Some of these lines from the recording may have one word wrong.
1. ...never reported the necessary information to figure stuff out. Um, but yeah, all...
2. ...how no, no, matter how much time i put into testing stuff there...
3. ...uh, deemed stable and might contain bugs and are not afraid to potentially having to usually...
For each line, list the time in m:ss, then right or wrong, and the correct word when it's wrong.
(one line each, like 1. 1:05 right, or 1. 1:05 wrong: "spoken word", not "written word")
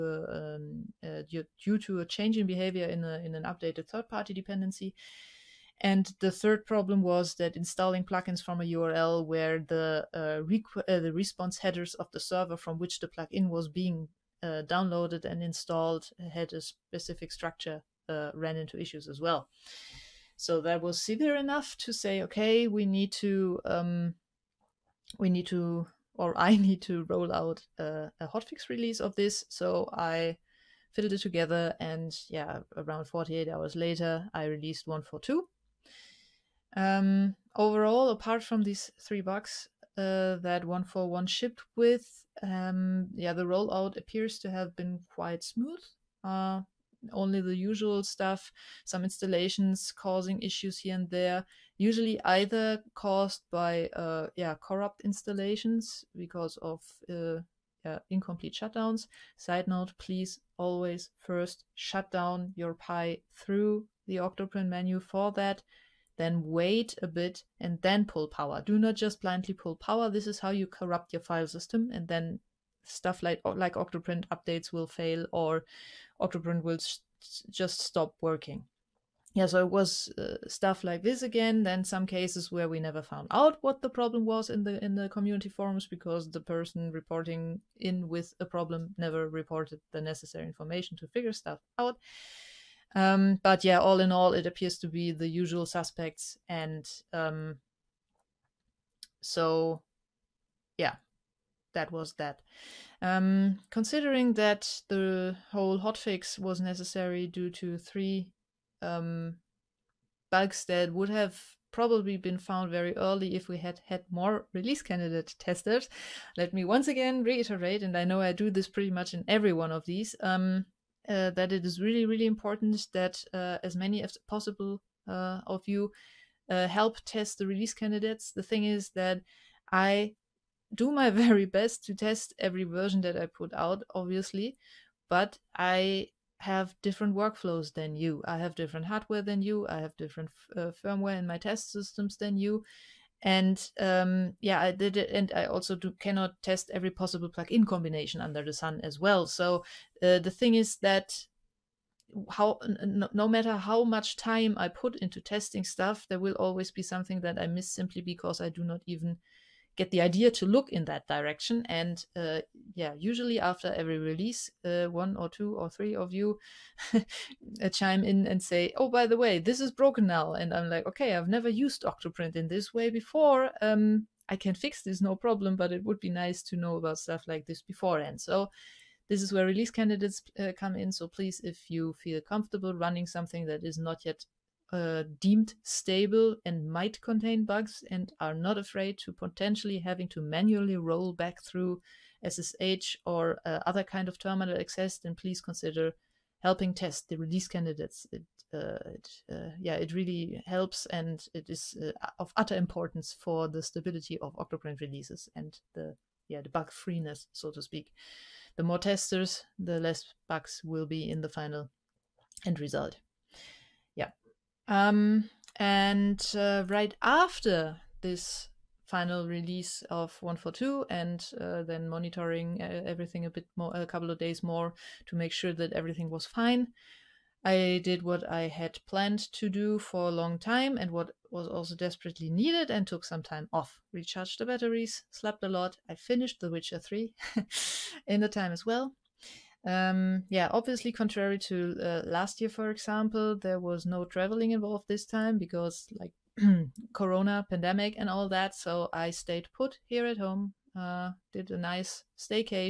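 1. 1:28 right
2. 2:32 right
3. 3:04 wrong: "manually", not "usually".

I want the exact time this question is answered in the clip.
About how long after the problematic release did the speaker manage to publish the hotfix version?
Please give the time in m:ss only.
0:33.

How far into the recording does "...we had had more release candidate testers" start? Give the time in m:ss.
1:53.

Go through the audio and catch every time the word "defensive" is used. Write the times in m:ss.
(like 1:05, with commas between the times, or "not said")
not said.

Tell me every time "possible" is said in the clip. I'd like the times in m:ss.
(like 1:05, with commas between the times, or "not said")
2:04, 2:26.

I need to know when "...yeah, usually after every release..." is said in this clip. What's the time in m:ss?
2:42.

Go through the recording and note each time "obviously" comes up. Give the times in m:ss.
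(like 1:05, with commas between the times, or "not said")
2:13, 4:00.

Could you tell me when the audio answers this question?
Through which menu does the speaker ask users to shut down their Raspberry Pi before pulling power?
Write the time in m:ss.
1:04.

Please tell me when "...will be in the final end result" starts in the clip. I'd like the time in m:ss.
3:30.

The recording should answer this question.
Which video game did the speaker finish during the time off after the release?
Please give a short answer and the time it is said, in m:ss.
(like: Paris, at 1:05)
The Witcher 3, at 3:56.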